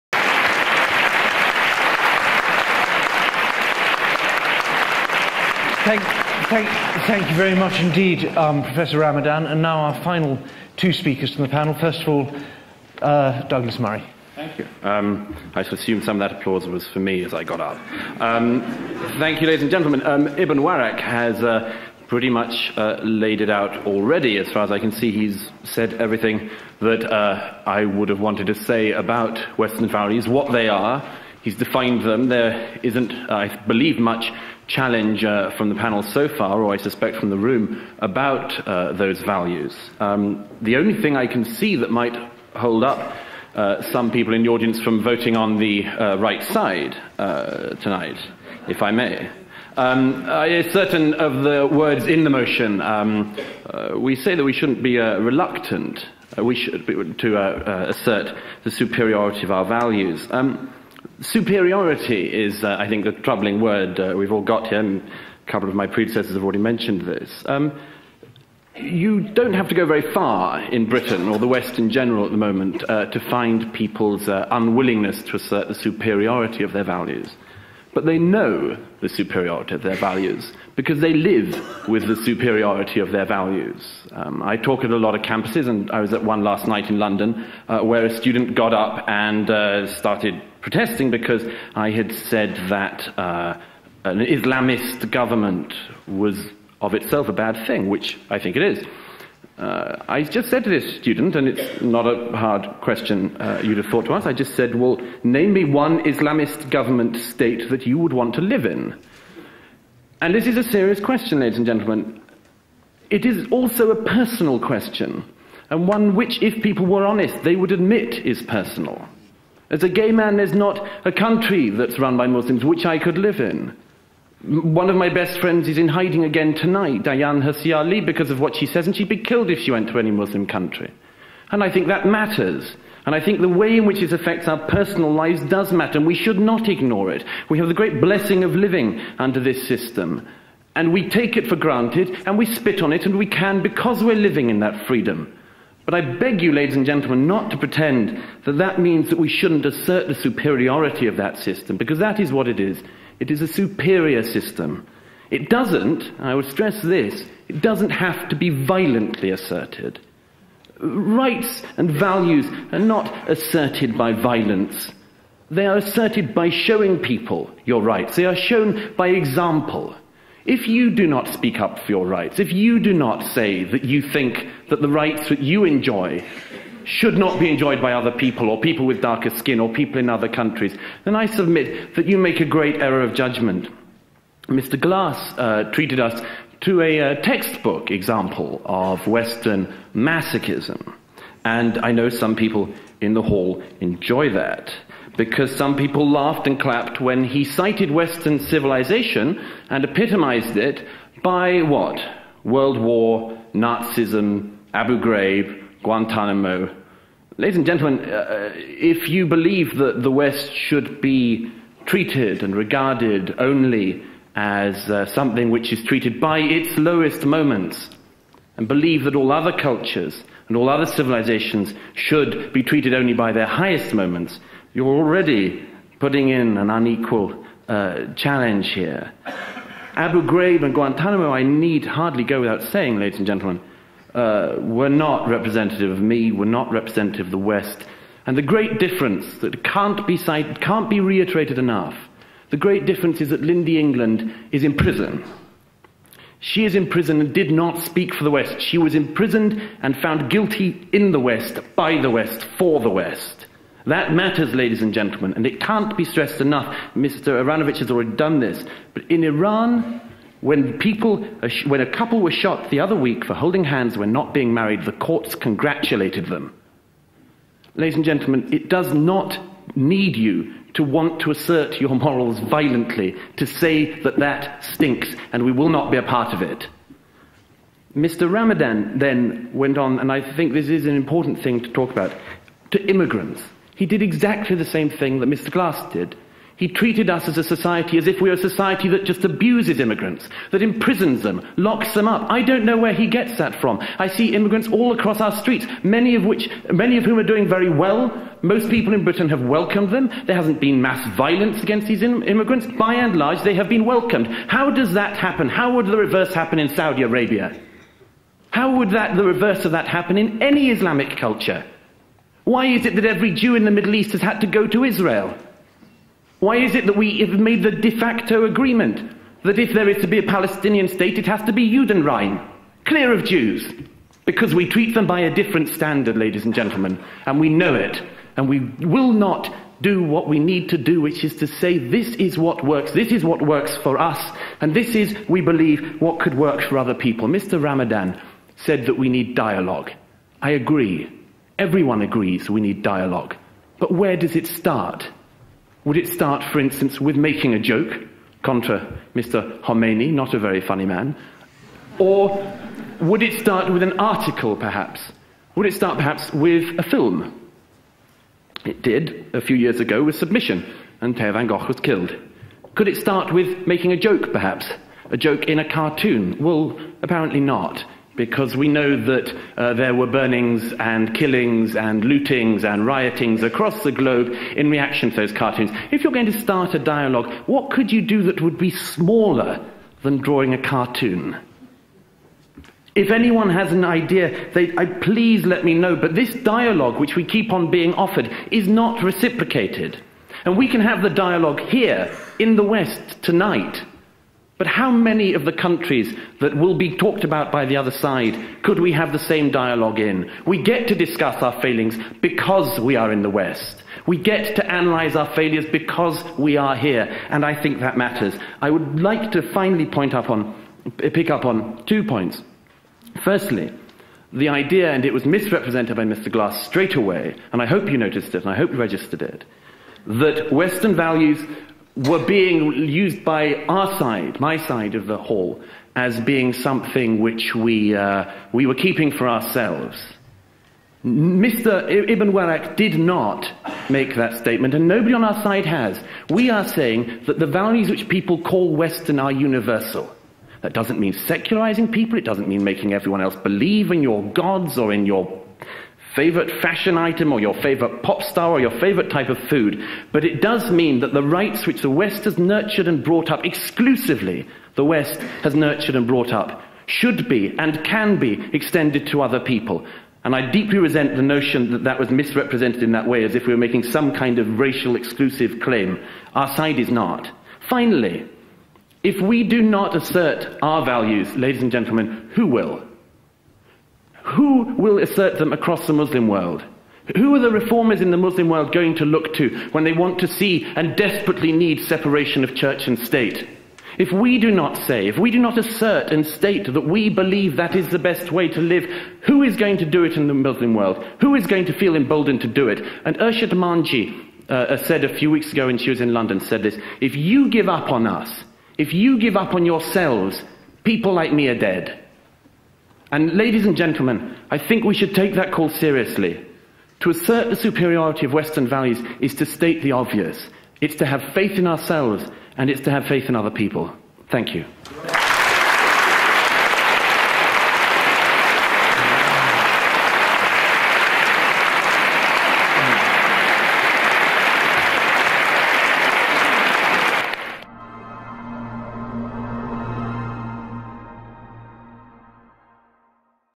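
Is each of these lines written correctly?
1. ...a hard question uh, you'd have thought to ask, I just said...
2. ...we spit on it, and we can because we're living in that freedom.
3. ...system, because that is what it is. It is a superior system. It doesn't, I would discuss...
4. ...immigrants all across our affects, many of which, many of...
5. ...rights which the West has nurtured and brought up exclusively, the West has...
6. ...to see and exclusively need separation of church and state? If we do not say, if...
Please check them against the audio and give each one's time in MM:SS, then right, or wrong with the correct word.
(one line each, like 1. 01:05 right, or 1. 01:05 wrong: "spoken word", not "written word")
1. 01:42 right
2. 02:22 right
3. 02:31 wrong: "stress", not "discuss"
4. 04:54 wrong: "streets", not "affects"
5. 07:31 right
6. 08:00 wrong: "desperately", not "exclusively".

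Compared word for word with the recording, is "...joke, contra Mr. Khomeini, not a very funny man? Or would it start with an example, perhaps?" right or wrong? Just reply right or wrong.
wrong.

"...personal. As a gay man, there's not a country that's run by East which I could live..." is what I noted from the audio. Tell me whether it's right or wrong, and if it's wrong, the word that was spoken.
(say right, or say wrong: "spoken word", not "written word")
wrong: "Muslims", not "East".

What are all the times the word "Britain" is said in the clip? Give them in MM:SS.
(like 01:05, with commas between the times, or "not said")
01:10, 04:59.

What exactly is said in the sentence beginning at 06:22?
If anyone has an idea, they, I, please let me know.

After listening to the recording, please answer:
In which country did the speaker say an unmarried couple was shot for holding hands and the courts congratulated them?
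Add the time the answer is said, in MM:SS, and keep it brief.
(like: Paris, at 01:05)
Iran, at 04:19.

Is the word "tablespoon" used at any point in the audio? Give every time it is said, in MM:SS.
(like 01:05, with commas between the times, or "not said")
not said.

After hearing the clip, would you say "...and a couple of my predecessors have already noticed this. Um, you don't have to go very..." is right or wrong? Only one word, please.
wrong.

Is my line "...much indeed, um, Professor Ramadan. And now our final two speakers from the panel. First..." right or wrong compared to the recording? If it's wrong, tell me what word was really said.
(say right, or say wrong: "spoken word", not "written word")
right.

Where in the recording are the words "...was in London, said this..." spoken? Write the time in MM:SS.
08:15.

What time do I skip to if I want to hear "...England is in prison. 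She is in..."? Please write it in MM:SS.
04:03.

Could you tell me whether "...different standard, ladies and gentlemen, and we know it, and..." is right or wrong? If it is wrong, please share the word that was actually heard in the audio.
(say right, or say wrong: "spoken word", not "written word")
right.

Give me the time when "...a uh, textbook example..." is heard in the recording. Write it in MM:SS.
03:06.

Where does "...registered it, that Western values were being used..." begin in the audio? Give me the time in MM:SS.
06:58.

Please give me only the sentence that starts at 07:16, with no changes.
We are saying that the values which people call Western are universal.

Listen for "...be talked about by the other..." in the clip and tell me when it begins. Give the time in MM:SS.
06:36.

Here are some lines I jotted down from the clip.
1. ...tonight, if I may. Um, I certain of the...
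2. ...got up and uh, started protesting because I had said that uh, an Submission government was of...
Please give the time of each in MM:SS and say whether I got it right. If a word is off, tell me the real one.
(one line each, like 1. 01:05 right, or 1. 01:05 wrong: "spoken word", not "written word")
1. 00:47 right
2. 01:28 wrong: "Islamist", not "Submission".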